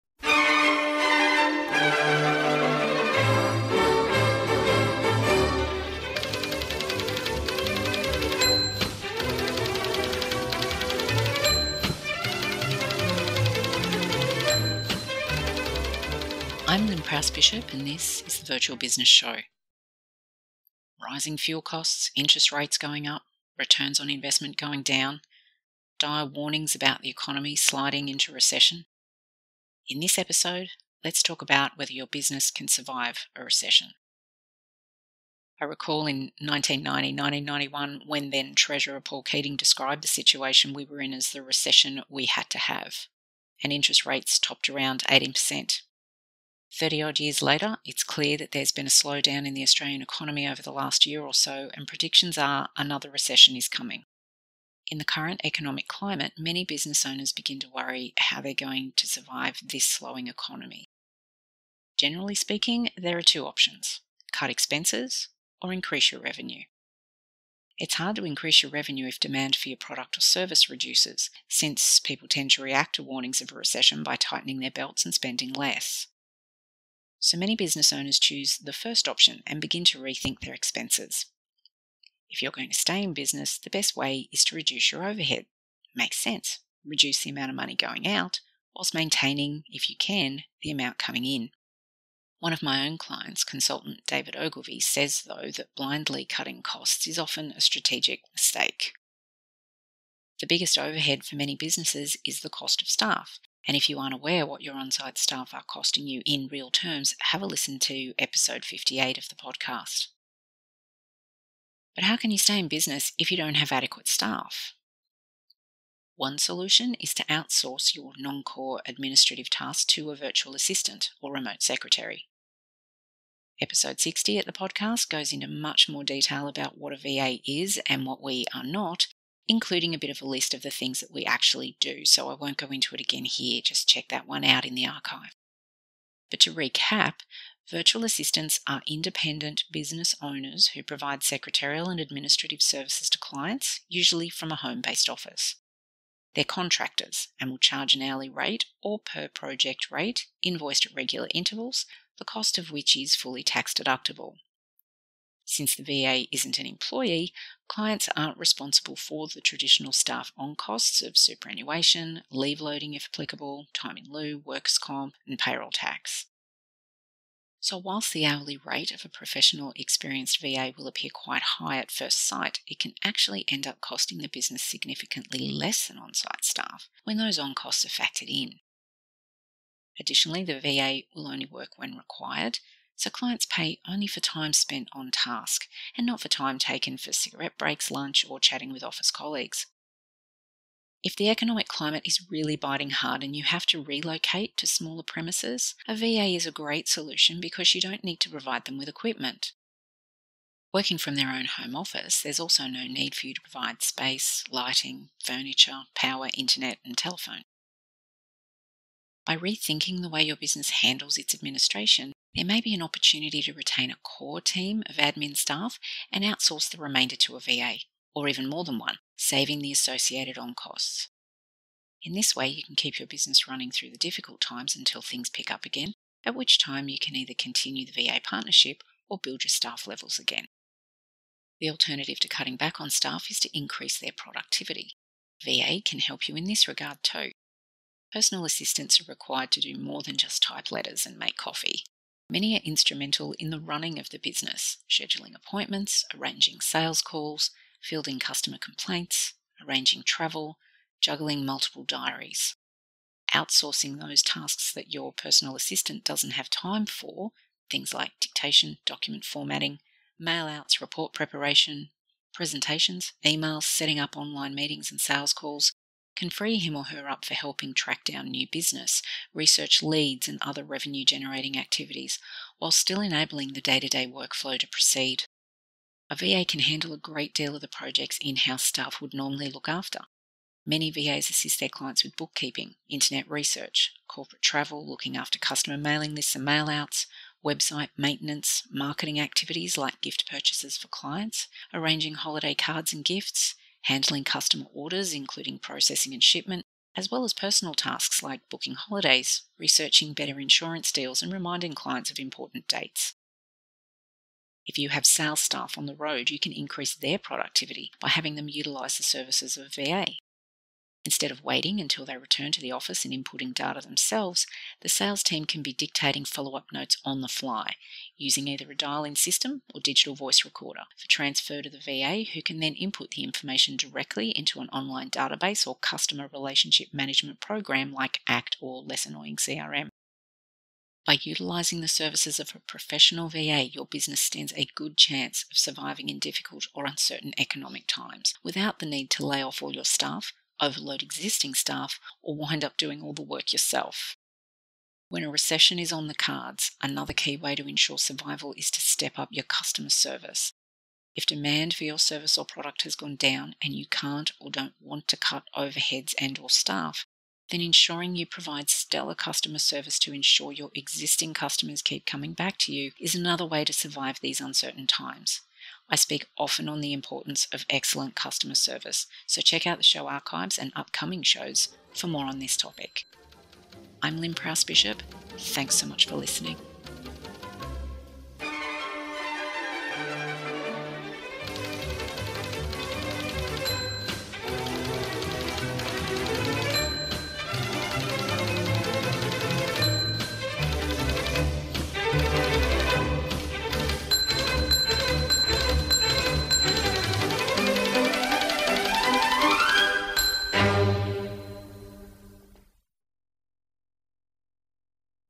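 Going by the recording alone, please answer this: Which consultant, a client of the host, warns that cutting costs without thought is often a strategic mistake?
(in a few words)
David Ogilvie.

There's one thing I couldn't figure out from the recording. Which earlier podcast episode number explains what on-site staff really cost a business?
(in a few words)
58.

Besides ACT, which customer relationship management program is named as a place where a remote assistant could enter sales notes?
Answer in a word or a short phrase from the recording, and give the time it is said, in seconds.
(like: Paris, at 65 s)
Less Annoying CRM, at 328 s.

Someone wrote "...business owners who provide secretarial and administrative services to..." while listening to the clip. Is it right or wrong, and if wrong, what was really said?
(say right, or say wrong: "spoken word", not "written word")
right.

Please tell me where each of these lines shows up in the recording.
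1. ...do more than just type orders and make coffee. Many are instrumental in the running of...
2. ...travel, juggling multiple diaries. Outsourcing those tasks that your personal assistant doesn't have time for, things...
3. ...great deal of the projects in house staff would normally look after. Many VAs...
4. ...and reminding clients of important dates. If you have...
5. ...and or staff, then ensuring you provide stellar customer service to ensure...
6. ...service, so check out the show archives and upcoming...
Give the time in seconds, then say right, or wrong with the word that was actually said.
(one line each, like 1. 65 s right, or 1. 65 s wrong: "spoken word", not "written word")
1. 239 s wrong: "letters", not "orders"
2. 250 s right
3. 276 s right
4. 301 s right
5. 356 s right
6. 368 s right.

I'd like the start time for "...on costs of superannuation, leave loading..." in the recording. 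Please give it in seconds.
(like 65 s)
160 s.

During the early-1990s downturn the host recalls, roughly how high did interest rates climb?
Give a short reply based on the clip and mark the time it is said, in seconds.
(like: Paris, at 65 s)
18%, at 45 s.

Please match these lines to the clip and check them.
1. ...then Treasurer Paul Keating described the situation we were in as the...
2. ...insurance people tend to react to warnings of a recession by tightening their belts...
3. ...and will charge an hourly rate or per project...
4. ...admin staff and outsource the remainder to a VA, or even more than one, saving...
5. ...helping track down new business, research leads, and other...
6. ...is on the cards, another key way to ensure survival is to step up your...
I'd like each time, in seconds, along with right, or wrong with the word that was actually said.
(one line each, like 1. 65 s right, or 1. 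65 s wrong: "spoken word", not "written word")
1. 38 s right
2. 71 s wrong: "since", not "insurance"
3. 147 s right
4. 214 s right
5. 267 s right
6. 345 s right.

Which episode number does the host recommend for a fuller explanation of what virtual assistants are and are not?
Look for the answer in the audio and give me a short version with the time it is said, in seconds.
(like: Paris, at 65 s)
60, at 123 s.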